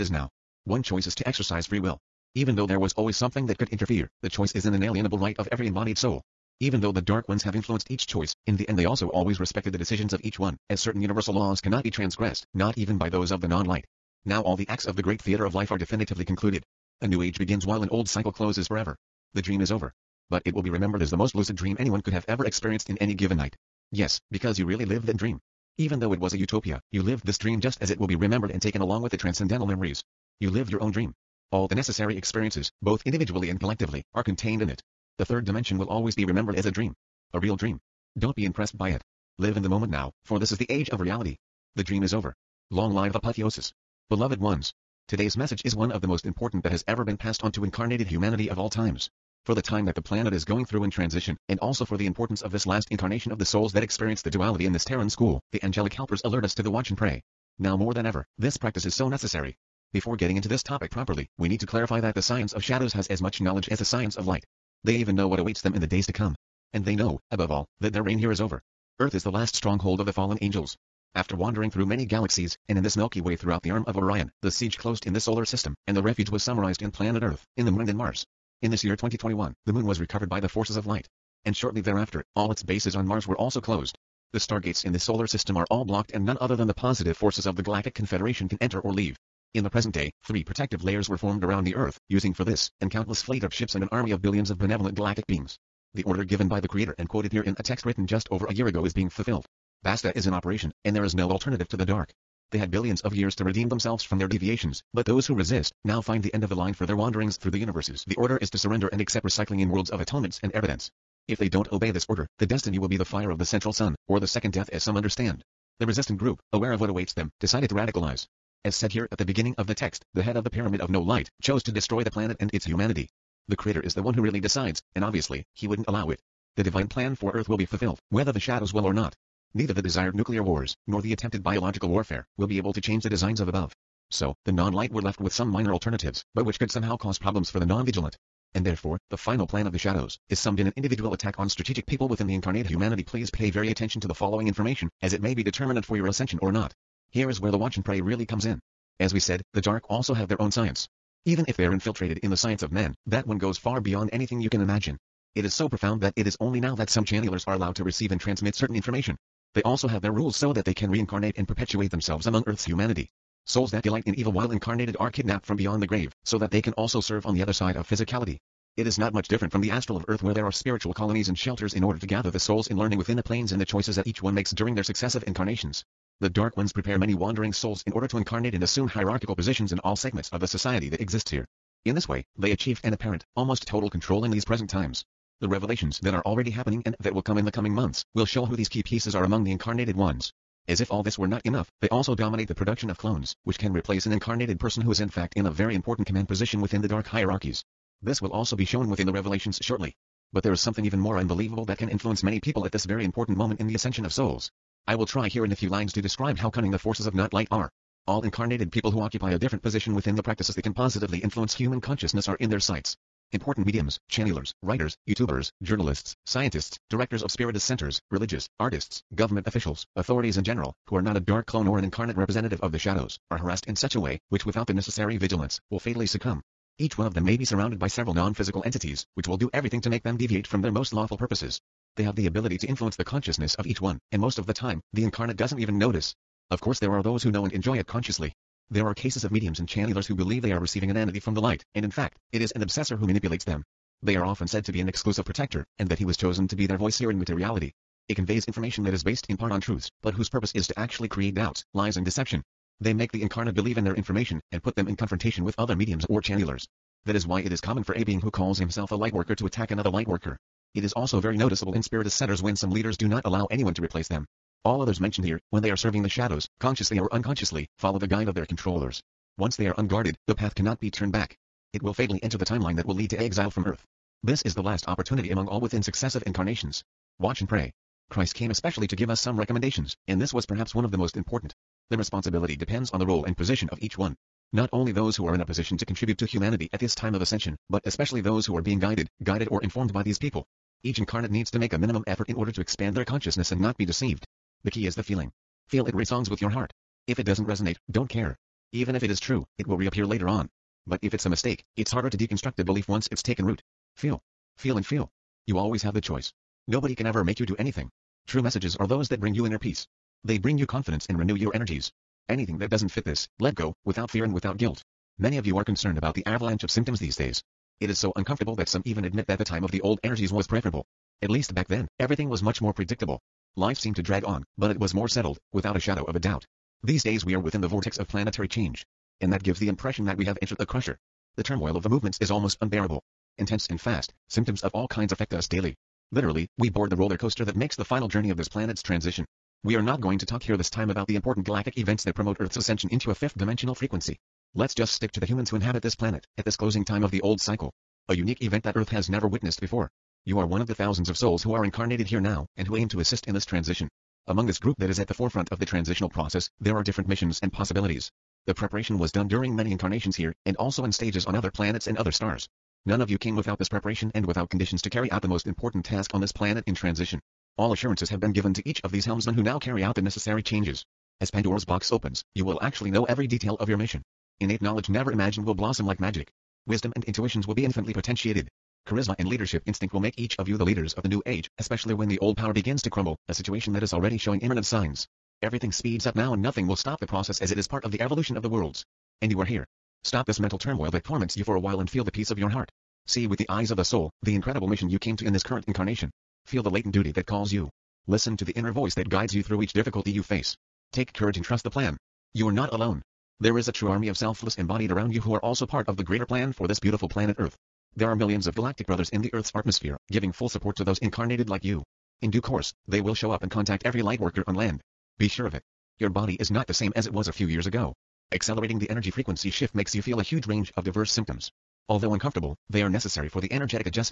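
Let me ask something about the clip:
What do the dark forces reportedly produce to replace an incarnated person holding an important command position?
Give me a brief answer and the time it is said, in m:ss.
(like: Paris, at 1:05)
clones, at 3:12.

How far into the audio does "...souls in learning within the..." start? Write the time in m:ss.
2:52.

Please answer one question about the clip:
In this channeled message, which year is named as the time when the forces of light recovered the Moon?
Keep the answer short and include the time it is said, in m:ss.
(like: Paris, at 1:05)
2021, at 1:18.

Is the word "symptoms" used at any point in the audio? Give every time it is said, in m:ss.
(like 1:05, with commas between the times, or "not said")
5:16, 5:34, 7:01.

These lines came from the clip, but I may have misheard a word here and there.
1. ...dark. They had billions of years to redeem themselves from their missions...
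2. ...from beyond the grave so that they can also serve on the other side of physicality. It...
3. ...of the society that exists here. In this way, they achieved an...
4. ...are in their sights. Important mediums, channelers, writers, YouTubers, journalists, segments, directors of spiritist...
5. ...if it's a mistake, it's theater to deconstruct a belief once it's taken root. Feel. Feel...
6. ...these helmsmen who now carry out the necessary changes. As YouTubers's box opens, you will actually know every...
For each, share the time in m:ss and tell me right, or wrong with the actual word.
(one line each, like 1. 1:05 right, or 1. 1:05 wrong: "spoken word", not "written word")
1. 1:41 wrong: "deviations", not "missions"
2. 2:45 right
3. 3:00 right
4. 3:32 wrong: "scientists", not "segments"
5. 5:01 wrong: "harder", not "theater"
6. 6:08 wrong: "Pandora", not "YouTubers".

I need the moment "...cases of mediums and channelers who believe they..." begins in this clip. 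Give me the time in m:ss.
3:58.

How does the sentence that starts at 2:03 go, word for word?
The creator is the one who really decides, and obviously, he wouldn't allow it.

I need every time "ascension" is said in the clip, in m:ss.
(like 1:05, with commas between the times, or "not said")
2:26, 3:23, 4:47, 5:42.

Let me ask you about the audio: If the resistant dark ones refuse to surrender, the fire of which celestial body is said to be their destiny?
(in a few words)
the central sun.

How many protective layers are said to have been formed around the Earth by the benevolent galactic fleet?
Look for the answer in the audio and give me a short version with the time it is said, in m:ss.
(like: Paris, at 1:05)
3, at 1:30.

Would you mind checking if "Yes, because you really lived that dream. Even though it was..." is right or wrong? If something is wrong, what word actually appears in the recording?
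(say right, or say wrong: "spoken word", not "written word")
right.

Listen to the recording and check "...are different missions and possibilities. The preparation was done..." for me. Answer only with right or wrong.
right.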